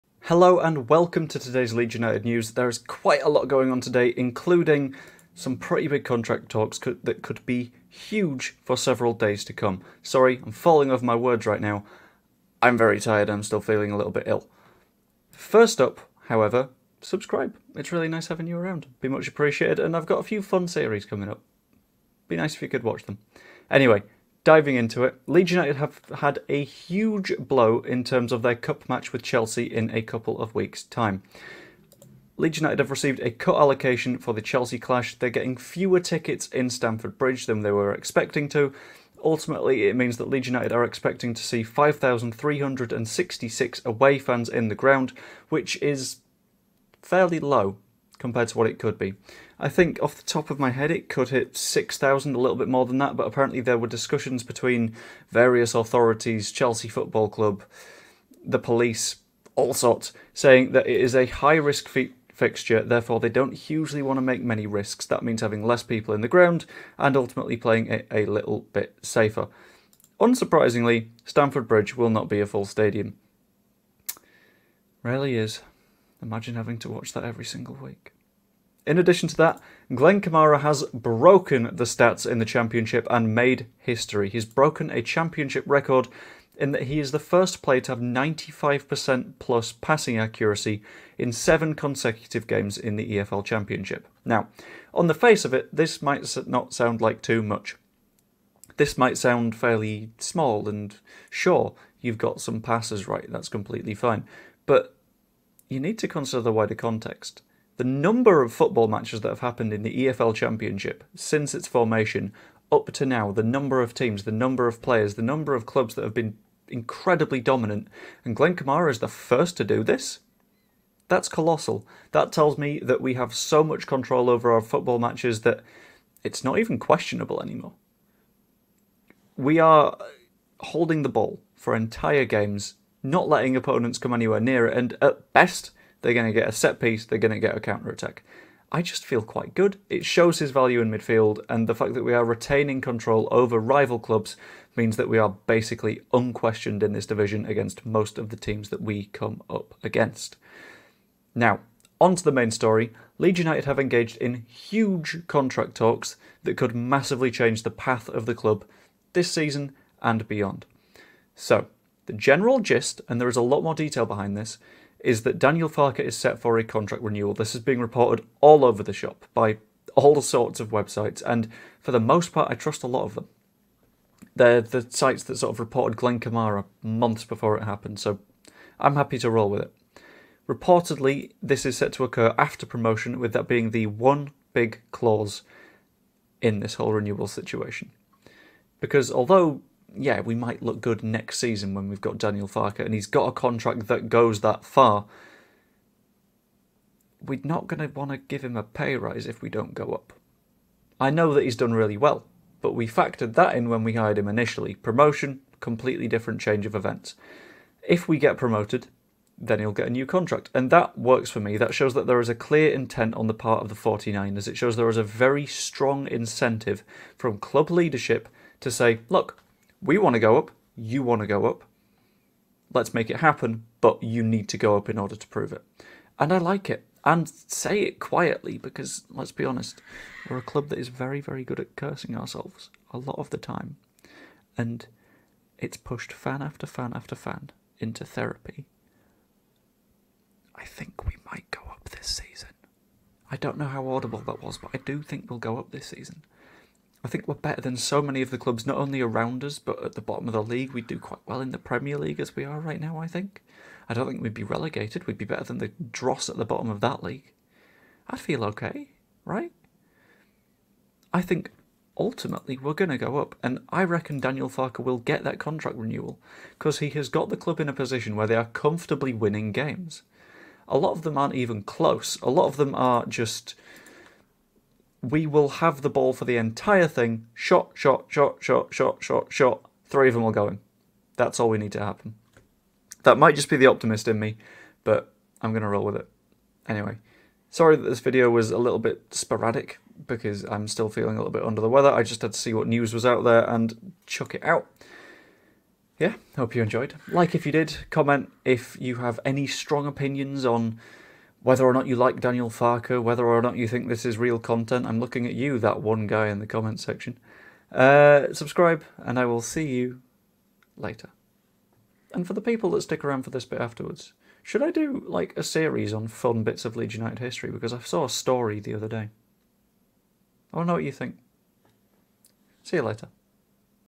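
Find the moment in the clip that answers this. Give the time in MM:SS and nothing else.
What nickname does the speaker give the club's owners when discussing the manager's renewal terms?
03:33.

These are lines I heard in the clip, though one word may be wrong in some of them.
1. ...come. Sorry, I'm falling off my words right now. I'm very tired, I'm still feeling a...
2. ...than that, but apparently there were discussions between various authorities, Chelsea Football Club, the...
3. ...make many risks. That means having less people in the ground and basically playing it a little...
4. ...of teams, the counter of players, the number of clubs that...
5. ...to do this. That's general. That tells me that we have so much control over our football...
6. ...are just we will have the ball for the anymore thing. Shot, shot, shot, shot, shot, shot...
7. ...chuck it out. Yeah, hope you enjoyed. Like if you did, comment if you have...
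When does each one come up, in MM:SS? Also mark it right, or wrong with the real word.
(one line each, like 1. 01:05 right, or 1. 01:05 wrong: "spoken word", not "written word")
1. 00:09 right
2. 00:52 right
3. 01:04 wrong: "ultimately", not "basically"
4. 01:53 wrong: "number", not "counter"
5. 01:59 wrong: "colossal", not "general"
6. 04:32 wrong: "entire", not "anymore"
7. 04:54 right.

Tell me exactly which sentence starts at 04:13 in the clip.
I don't think we'd be relegated.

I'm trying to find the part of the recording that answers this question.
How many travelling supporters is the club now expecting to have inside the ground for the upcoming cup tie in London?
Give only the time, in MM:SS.
00:41.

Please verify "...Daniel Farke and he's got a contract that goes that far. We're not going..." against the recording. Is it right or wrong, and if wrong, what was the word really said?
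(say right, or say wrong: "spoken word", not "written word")
right.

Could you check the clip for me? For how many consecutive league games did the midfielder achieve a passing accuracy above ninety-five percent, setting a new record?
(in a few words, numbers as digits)
7.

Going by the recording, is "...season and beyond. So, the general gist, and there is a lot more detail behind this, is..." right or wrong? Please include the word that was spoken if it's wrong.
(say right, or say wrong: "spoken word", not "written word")
right.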